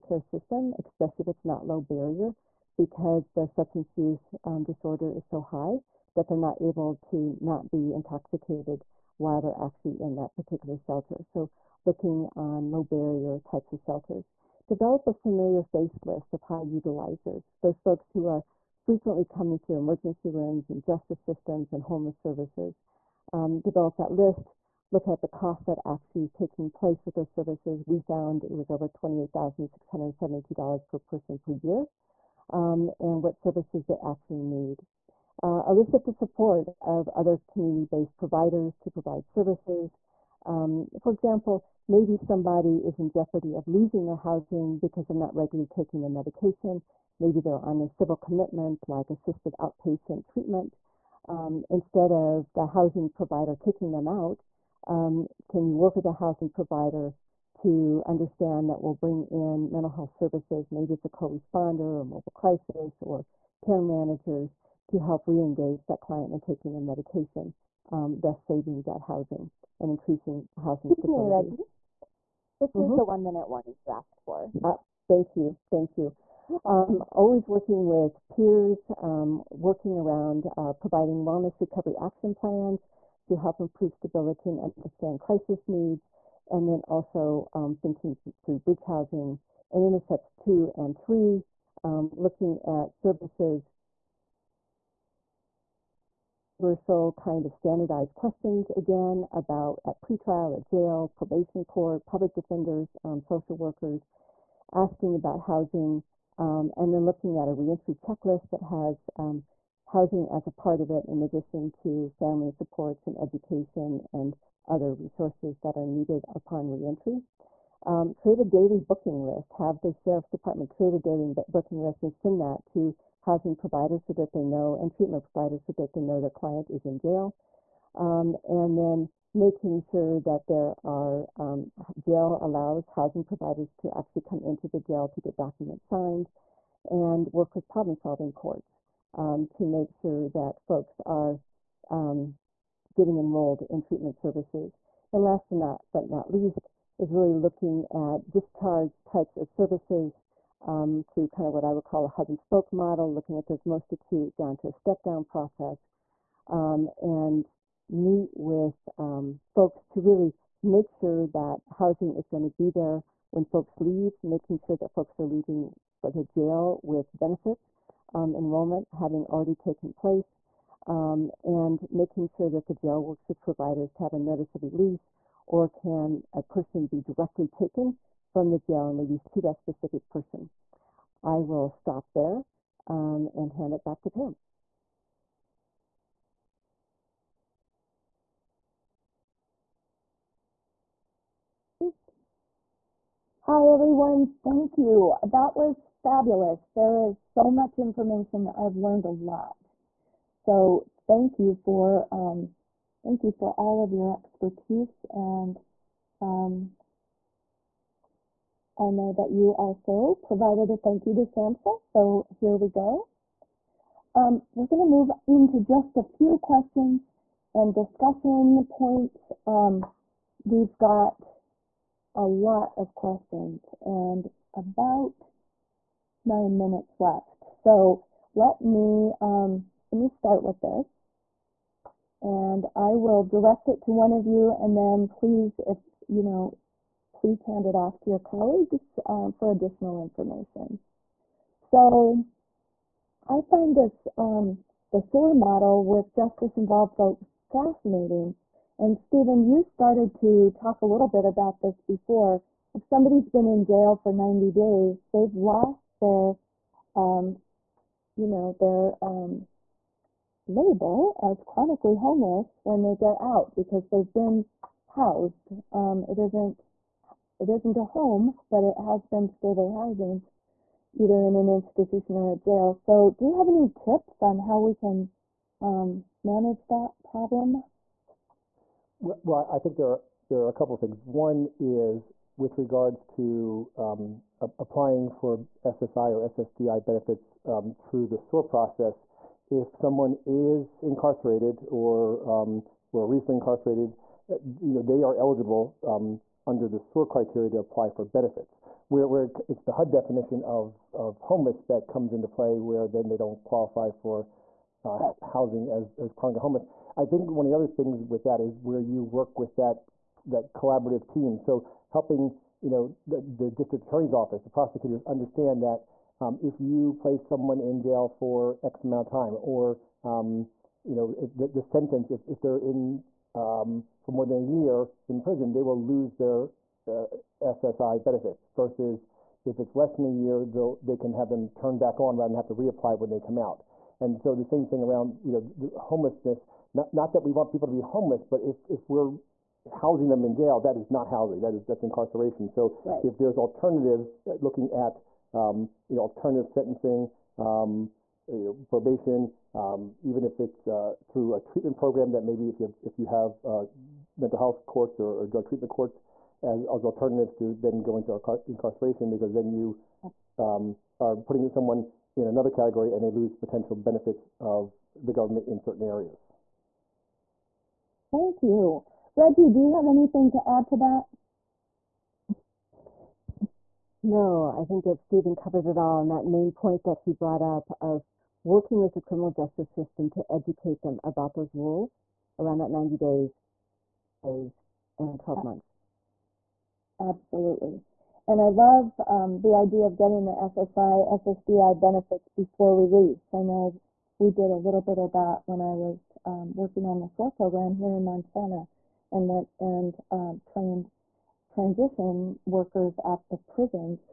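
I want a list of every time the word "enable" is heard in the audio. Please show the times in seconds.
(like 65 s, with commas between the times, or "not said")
not said.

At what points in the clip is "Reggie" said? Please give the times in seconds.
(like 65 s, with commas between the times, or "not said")
71 s, 369 s.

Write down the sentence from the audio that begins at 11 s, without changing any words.
So looking on low barrier types of shelters.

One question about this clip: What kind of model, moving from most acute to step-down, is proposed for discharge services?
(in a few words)
hub and spoke.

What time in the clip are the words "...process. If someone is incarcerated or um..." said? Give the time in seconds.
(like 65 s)
288 s.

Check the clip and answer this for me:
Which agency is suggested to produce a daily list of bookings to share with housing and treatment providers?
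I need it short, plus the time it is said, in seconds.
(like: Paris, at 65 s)
Sheriff's Department, at 120 s.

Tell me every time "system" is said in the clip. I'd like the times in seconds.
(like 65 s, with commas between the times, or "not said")
0 s, 21 s, 379 s.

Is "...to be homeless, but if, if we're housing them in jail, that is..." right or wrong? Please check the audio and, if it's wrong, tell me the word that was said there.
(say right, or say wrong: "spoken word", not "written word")
right.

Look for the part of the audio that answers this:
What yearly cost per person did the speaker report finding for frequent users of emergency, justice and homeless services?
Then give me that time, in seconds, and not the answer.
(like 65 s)
28 s.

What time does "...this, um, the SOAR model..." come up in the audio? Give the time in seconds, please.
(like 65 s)
243 s.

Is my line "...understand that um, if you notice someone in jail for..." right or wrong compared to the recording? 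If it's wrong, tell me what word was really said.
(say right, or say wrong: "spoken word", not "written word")
wrong: "place", not "notice".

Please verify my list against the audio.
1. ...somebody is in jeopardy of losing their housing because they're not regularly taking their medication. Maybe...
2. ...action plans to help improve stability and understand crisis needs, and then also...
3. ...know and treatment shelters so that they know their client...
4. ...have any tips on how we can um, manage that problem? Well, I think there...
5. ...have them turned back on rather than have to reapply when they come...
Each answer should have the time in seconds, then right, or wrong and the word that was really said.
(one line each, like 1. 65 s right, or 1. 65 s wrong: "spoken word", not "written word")
1. 42 s right
2. 81 s right
3. 124 s wrong: "providers", not "shelters"
4. 273 s right
5. 331 s right.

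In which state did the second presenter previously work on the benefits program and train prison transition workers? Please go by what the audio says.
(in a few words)
Montana.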